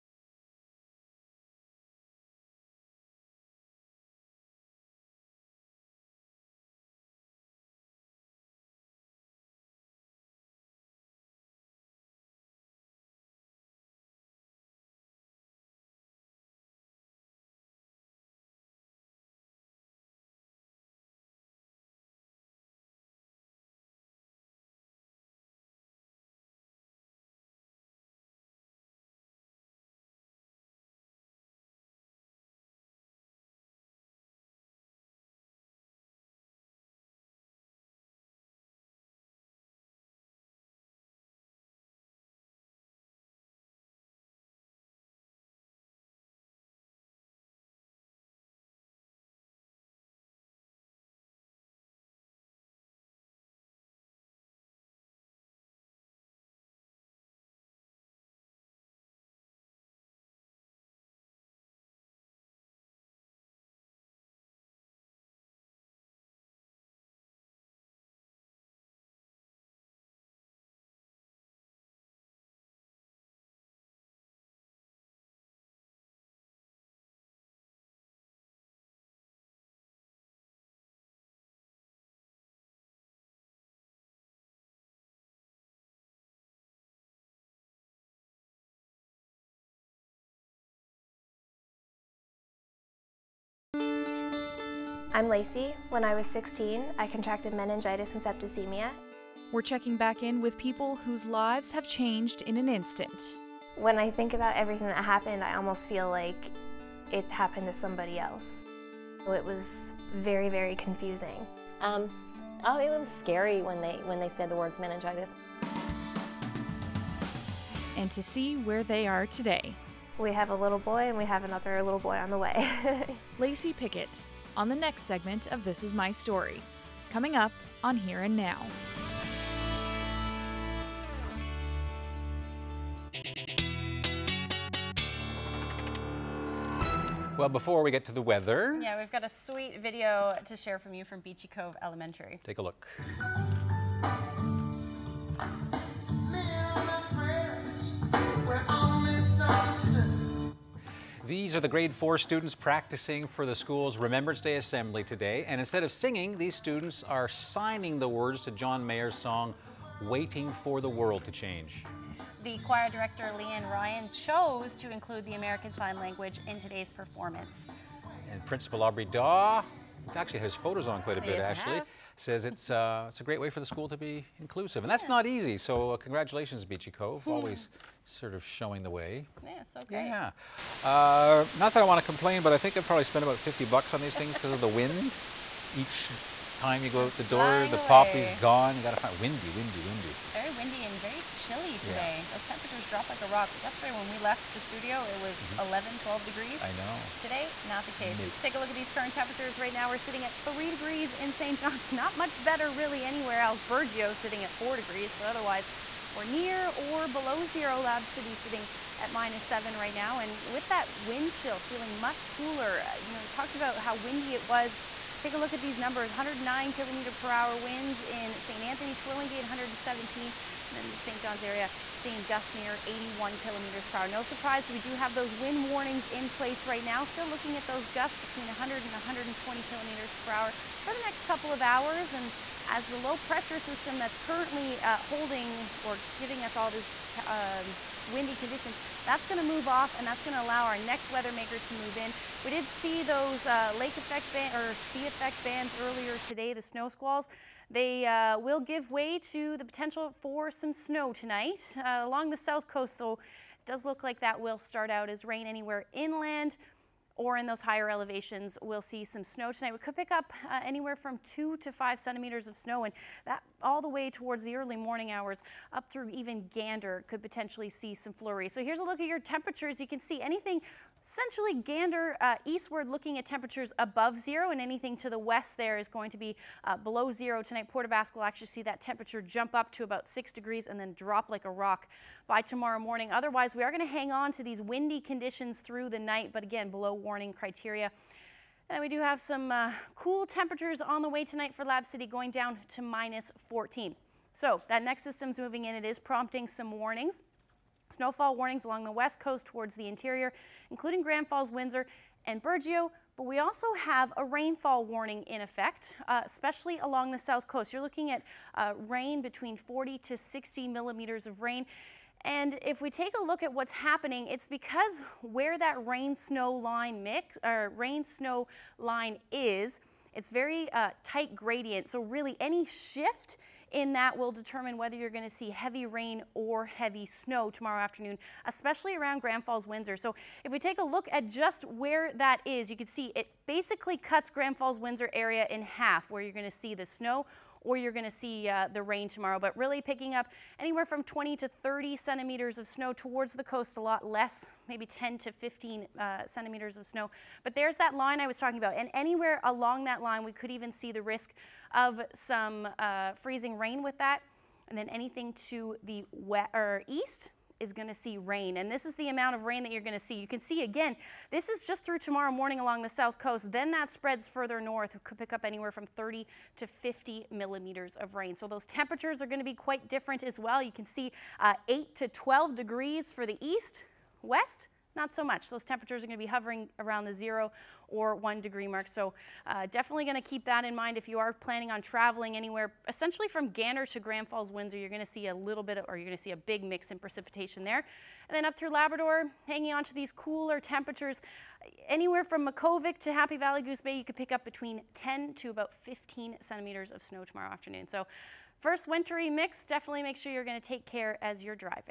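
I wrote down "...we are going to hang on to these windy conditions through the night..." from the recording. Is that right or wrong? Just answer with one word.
right.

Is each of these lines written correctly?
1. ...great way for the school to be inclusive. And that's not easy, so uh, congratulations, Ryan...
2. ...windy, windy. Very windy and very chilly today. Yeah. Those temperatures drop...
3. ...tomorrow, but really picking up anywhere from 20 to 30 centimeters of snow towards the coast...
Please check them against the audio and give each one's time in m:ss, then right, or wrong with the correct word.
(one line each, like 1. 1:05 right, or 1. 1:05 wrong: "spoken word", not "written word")
1. 2:53 wrong: "Beachy", not "Ryan"
2. 3:09 right
3. 5:39 right.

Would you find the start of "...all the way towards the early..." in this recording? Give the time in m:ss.
4:23.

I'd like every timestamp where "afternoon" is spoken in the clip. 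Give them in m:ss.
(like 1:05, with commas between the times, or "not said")
5:27, 6:37.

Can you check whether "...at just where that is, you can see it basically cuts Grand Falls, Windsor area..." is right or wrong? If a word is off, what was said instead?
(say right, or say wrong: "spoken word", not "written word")
right.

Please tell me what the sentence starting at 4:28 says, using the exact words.
So here's a look at your temperatures.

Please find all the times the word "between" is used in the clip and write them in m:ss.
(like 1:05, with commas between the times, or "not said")
3:48, 5:09, 6:34.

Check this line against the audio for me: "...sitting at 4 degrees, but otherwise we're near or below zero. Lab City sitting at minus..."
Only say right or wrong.
right.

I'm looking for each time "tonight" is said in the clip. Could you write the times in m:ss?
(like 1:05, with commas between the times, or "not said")
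4:11, 4:19, 4:37, 4:51.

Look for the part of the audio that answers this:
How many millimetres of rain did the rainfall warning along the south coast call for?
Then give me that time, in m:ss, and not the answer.
5:09.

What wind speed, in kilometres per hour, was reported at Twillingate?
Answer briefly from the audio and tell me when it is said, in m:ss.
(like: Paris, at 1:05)
117, at 3:39.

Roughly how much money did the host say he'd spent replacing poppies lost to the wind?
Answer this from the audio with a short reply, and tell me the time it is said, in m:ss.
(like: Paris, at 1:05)
$50, at 3:03.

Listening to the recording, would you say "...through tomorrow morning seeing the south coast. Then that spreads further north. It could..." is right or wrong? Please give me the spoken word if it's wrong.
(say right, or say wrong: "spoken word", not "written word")
wrong: "along", not "seeing".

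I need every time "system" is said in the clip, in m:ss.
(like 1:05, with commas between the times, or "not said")
3:53, 4:55.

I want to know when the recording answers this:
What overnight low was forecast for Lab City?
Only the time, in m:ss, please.
4:52.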